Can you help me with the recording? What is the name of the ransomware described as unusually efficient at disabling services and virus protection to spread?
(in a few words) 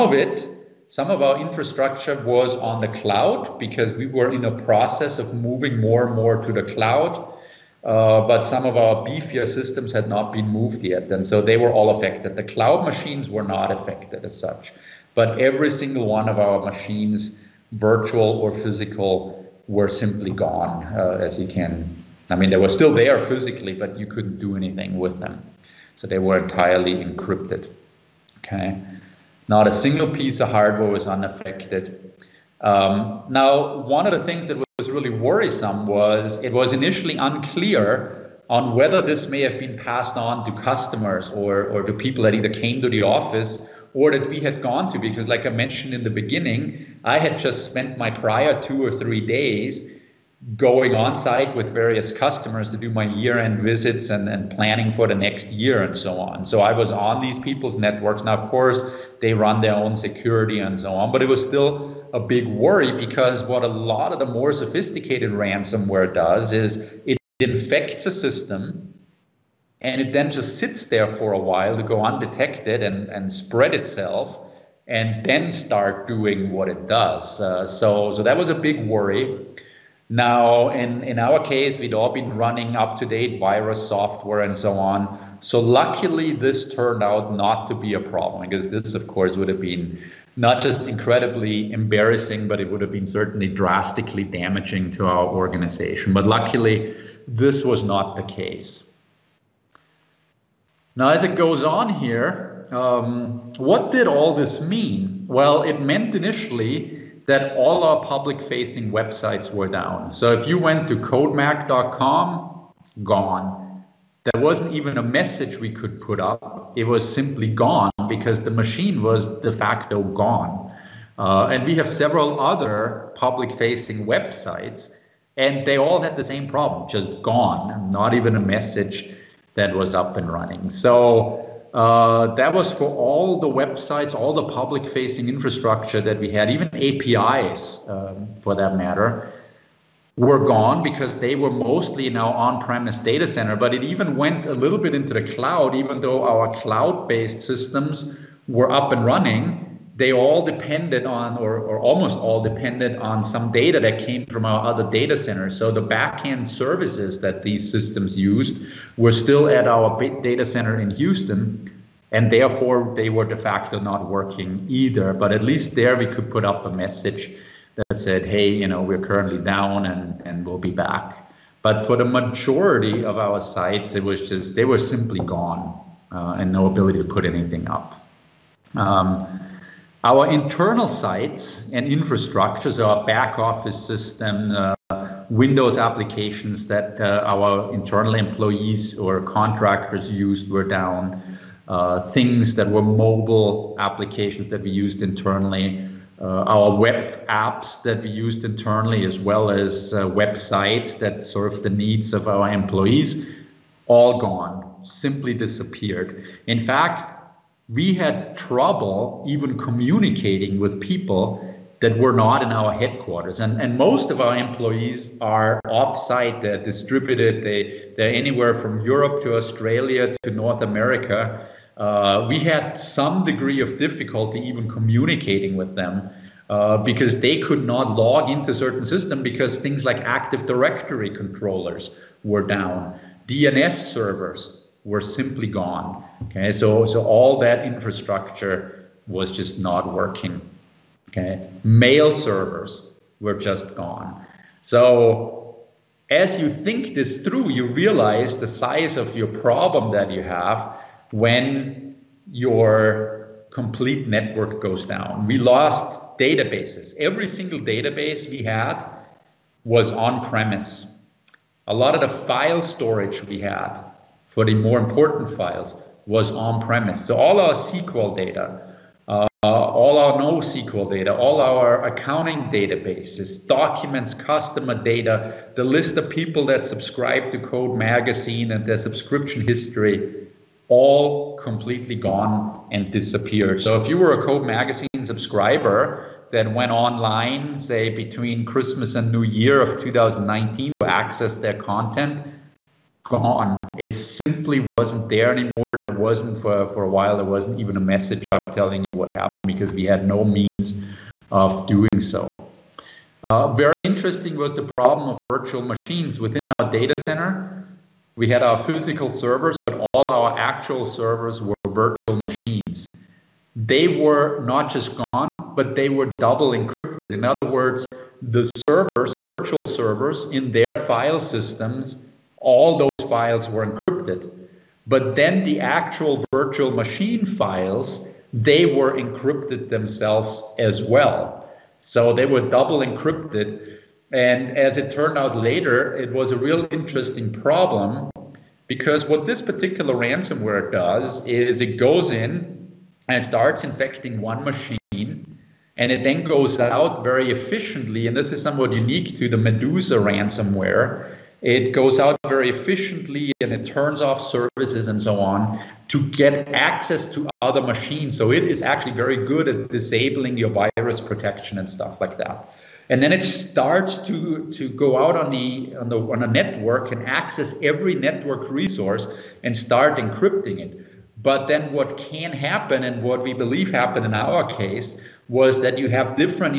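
Medusa.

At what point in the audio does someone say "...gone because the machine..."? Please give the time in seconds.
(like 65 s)
117 s.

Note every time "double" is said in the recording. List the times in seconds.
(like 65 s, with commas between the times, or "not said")
316 s, 332 s.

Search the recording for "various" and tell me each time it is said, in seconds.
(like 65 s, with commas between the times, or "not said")
51 s.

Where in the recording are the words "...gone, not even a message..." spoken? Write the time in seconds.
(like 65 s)
127 s.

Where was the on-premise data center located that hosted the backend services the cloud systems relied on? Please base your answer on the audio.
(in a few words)
Houston.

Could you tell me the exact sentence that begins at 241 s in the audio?
Okay, mail servers were just gone.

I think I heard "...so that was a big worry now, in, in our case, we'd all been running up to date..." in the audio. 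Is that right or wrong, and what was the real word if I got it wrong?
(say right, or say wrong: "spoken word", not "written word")
right.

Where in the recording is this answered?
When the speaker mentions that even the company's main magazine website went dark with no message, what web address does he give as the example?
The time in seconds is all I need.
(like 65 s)
110 s.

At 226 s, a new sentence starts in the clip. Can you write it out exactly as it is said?
Uh, because they could not log into certain system because things like Active Directory controllers were down, DNS servers were simply gone.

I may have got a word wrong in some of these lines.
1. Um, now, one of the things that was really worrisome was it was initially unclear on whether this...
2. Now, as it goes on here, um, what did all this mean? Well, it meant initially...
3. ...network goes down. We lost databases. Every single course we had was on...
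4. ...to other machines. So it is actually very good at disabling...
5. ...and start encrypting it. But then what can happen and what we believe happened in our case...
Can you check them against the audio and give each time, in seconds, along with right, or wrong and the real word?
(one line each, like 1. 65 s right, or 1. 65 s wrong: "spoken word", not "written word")
1. 32 s right
2. 100 s right
3. 254 s wrong: "database", not "course"
4. 357 s right
5. 369 s right.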